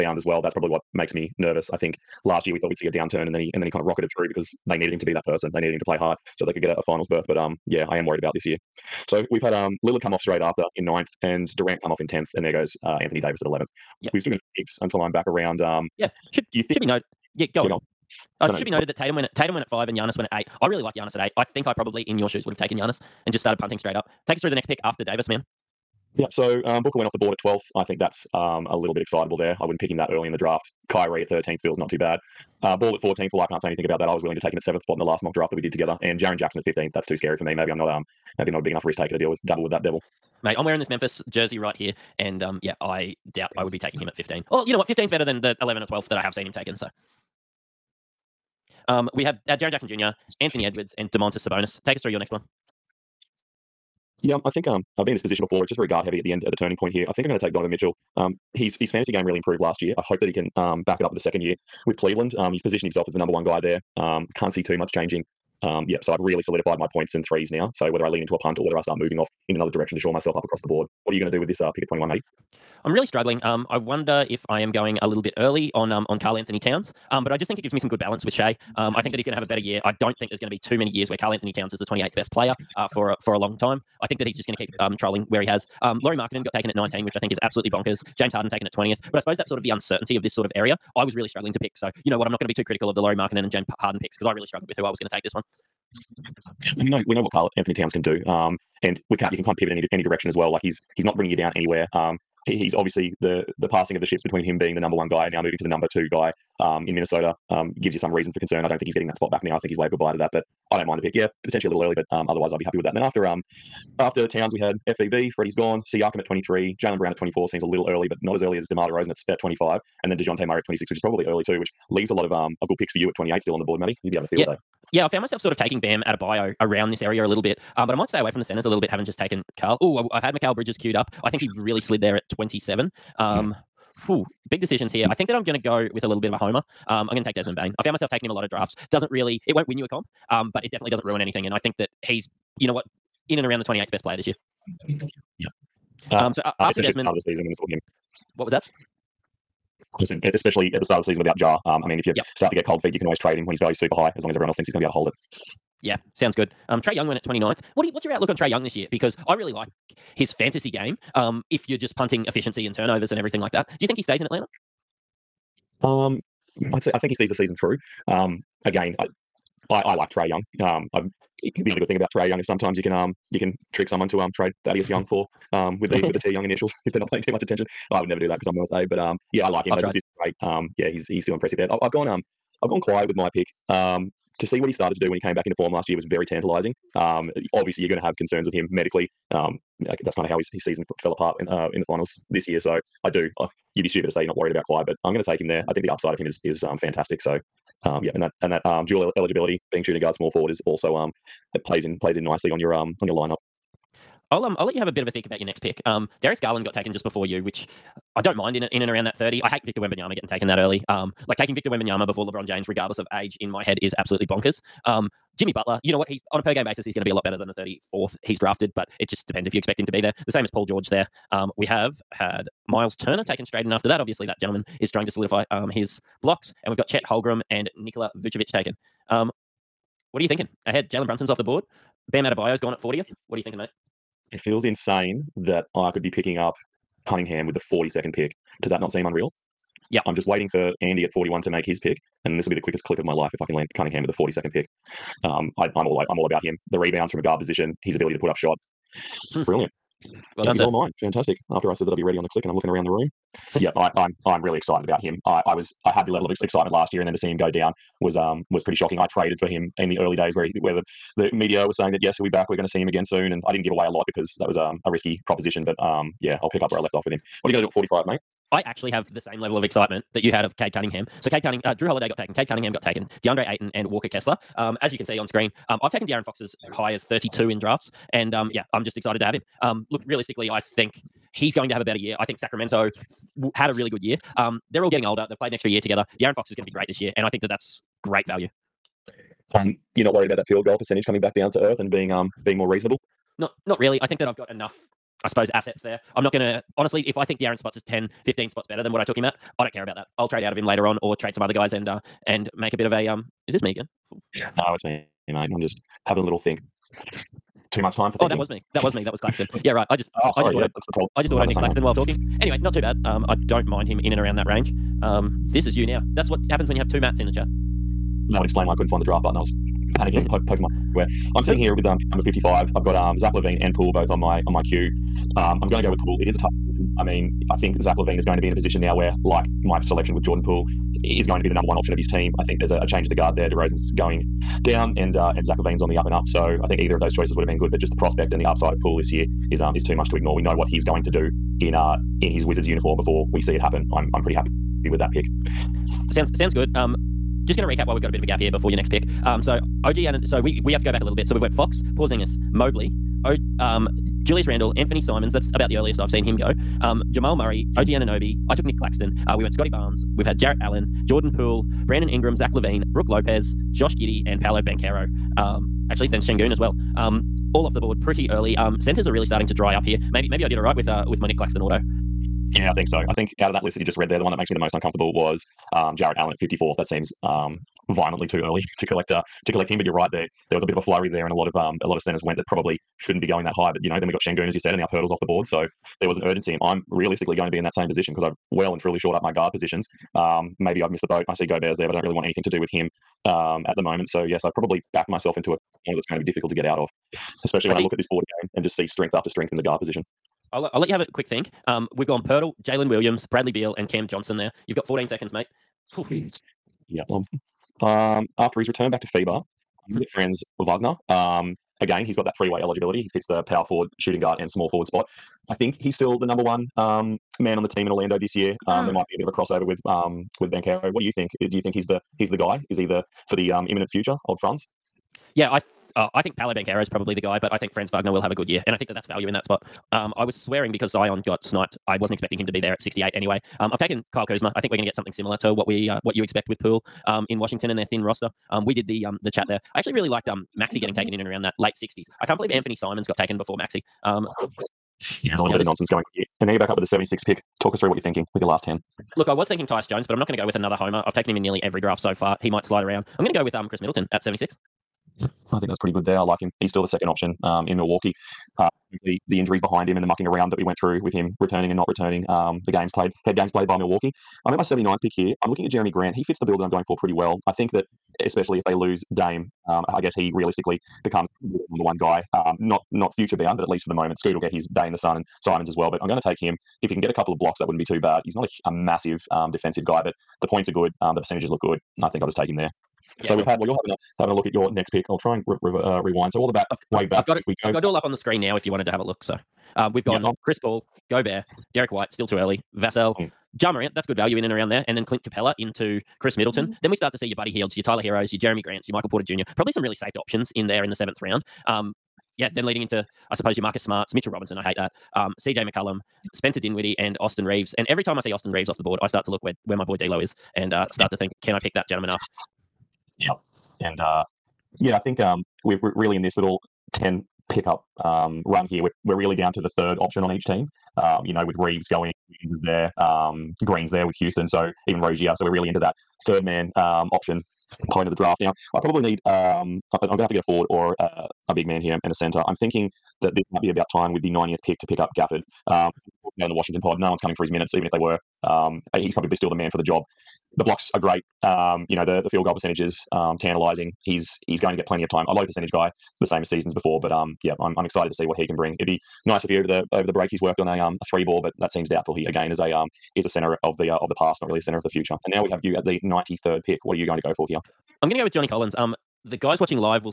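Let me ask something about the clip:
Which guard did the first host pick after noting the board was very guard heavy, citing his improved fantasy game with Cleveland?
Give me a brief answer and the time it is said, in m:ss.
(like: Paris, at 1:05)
Donovan Mitchell, at 0:57.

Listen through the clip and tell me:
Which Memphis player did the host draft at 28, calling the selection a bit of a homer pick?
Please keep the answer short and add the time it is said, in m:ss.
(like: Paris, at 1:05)
Desmond Bane, at 2:17.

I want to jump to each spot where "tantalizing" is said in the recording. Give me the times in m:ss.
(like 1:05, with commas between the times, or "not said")
3:06, 9:03.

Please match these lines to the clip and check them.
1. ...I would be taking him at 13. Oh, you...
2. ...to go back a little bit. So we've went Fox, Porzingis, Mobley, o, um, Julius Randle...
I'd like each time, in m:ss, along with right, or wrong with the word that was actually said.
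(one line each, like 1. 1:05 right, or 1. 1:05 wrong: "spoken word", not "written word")
1. 0:43 wrong: "15", not "13"
2. 5:50 right.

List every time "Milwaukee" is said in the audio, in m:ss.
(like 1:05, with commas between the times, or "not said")
7:37, 7:43.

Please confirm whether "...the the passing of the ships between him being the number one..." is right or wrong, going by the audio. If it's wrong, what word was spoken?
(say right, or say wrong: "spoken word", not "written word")
right.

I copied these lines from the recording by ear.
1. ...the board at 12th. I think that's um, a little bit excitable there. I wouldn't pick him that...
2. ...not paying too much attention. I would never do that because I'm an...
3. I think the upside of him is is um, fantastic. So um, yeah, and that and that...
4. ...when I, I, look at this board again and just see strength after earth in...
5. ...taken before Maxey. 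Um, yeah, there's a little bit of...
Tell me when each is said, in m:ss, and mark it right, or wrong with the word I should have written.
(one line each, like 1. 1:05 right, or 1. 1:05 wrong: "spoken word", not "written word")
1. 0:27 right
2. 2:56 right
3. 3:15 right
4. 6:37 wrong: "strength", not "earth"
5. 7:23 right.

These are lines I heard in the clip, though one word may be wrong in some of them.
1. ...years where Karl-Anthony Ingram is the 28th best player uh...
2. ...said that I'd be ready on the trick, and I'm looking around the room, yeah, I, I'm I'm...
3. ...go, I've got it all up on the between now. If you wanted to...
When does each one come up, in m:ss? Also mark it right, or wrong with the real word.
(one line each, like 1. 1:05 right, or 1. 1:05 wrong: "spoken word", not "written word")
1. 1:20 wrong: "Towns", not "Ingram"
2. 4:11 wrong: "click", not "trick"
3. 8:07 wrong: "screen", not "between".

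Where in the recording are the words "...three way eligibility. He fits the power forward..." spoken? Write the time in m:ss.
6:52.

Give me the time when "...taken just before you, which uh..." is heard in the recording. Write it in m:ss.
3:26.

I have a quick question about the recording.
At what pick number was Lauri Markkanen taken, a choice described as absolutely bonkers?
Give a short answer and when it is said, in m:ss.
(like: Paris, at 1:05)
19, at 1:26.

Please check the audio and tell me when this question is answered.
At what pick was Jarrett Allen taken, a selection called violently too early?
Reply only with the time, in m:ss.
6:16.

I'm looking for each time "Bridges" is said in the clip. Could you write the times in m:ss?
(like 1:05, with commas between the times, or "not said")
2:10.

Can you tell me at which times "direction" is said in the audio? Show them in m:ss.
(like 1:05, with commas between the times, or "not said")
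1:09, 1:40.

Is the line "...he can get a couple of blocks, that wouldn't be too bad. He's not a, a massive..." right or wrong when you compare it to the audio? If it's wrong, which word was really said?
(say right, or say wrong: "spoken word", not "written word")
right.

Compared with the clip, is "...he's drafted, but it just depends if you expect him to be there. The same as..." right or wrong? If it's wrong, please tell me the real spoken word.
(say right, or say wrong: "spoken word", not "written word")
right.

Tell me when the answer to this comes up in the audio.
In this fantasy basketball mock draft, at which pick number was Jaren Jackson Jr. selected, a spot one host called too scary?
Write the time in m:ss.
0:36.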